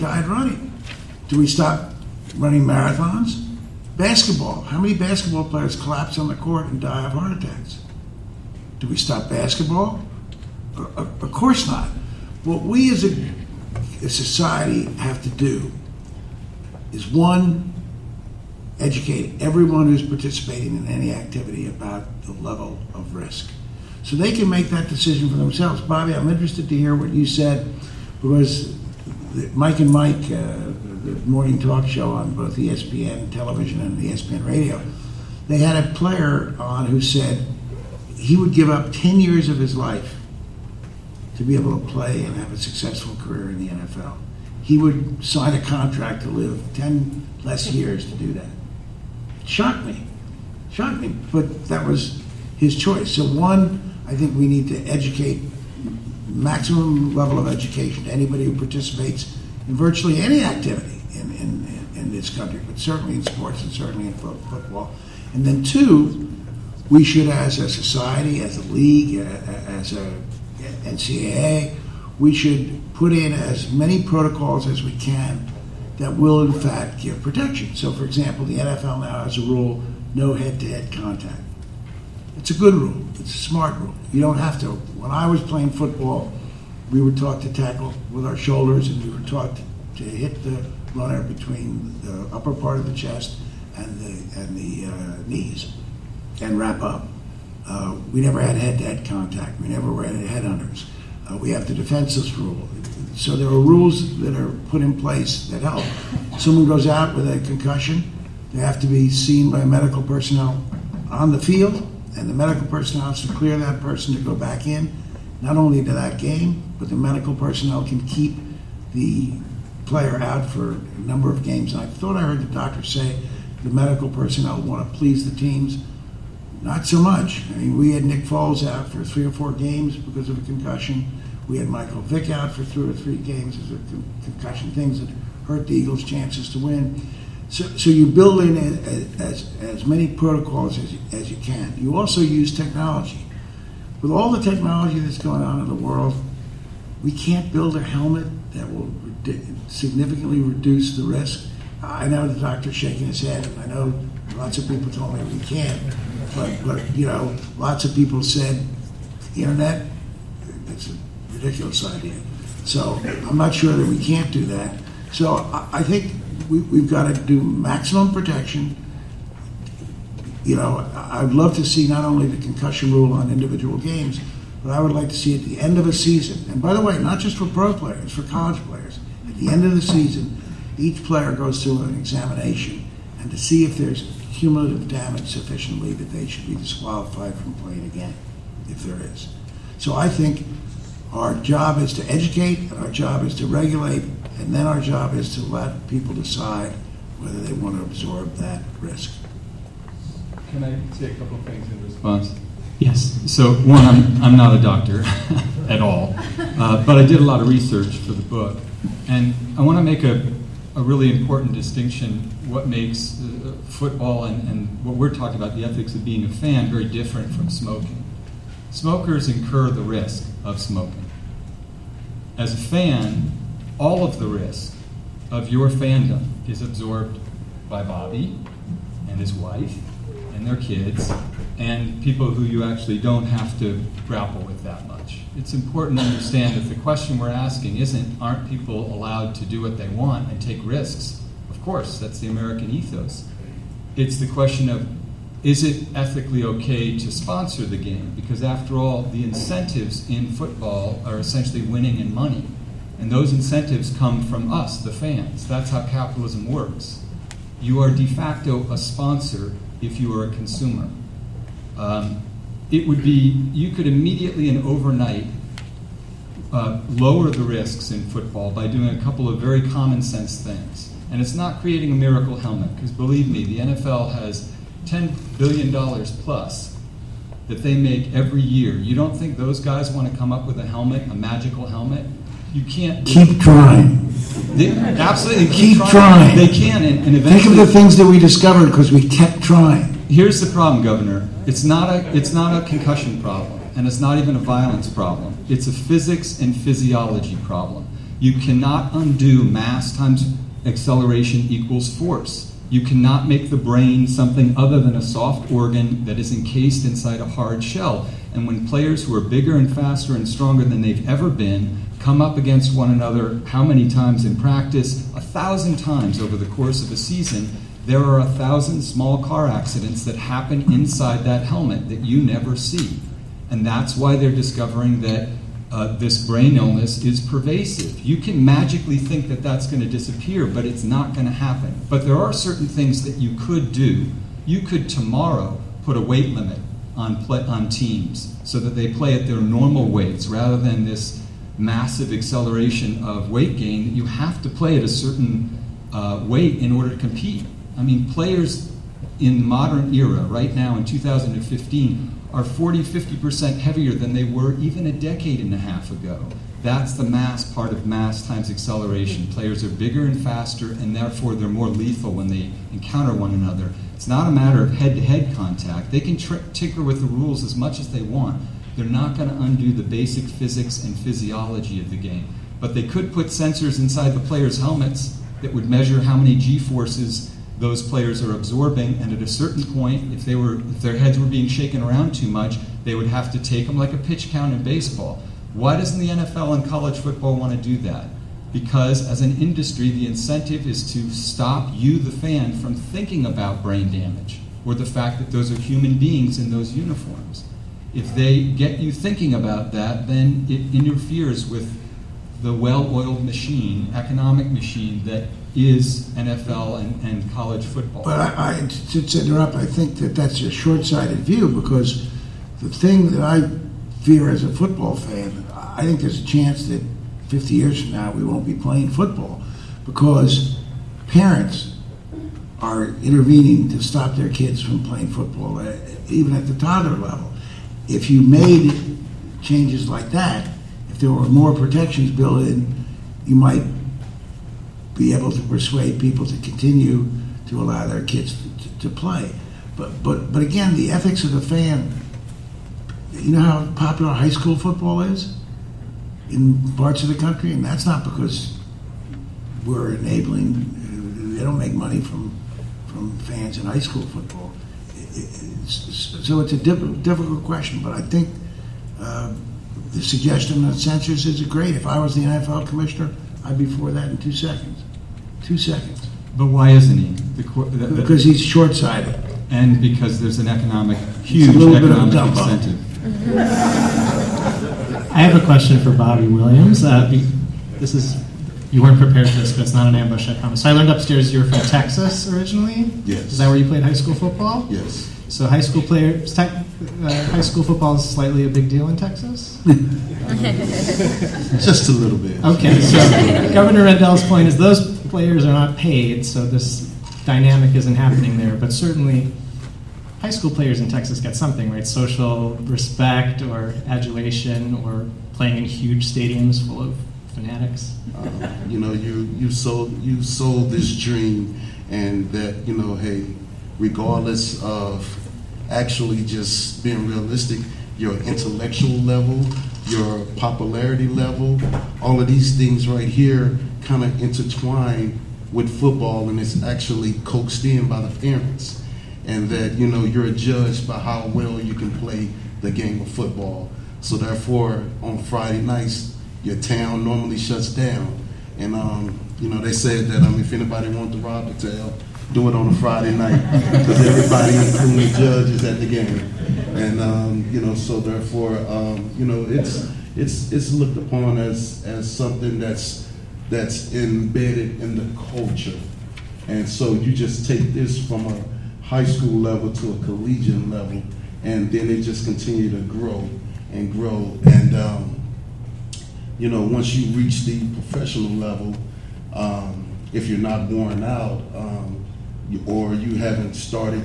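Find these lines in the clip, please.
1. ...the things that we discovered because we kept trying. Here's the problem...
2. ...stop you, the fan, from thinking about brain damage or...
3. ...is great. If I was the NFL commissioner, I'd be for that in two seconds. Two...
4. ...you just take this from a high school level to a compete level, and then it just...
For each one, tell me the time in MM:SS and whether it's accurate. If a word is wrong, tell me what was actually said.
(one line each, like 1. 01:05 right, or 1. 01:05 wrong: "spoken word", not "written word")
1. 04:47 right
2. 06:31 right
3. 07:41 right
4. 09:16 wrong: "collegiate", not "compete".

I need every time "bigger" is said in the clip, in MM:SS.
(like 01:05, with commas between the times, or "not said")
05:09, 05:59.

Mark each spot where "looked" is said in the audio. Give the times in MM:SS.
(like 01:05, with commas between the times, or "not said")
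09:10.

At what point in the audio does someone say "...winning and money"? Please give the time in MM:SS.
04:11.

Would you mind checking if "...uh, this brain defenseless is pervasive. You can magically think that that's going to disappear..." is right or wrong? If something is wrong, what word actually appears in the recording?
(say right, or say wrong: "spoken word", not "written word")
wrong: "illness", not "defenseless".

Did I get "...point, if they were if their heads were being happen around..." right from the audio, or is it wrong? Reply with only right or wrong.
wrong.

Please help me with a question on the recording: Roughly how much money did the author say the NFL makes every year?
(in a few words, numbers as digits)
$10 billion plus.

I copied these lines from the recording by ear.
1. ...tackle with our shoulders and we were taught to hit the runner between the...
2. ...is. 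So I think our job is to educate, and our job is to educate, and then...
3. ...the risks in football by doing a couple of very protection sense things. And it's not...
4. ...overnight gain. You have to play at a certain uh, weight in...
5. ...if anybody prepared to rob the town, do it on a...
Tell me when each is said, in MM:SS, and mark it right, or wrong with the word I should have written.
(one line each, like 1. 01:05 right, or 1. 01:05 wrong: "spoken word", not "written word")
1. 01:27 right
2. 03:09 wrong: "regulate", not "educate"
3. 04:27 wrong: "common", not "protection"
4. 05:43 wrong: "weight", not "overnight"
5. 09:00 wrong: "wanted", not "prepared".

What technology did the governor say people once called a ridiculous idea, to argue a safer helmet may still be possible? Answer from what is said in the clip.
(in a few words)
internet.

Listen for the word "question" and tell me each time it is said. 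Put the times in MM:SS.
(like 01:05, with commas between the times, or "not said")
03:56, 04:04, 07:37, 07:55.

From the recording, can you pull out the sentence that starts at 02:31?
I know the doctor's shaking his head, and I know lots of people told me we can't.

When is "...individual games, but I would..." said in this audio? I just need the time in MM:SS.
02:53.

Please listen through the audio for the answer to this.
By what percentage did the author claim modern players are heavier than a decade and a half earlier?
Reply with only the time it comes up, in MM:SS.
05:52.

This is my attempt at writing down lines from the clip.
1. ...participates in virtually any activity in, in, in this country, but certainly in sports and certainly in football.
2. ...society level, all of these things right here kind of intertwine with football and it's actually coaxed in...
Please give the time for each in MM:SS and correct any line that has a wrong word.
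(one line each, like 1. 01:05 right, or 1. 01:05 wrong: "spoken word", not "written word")
1. 00:58 right
2. 08:40 wrong: "popularity", not "society".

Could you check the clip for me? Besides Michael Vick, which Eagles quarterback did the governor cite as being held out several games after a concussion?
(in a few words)
Nick Foles.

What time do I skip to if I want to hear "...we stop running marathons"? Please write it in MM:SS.
00:01.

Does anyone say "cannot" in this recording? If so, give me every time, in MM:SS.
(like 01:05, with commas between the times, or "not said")
04:58, 05:02.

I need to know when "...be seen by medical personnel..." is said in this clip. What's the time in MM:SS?
01:48.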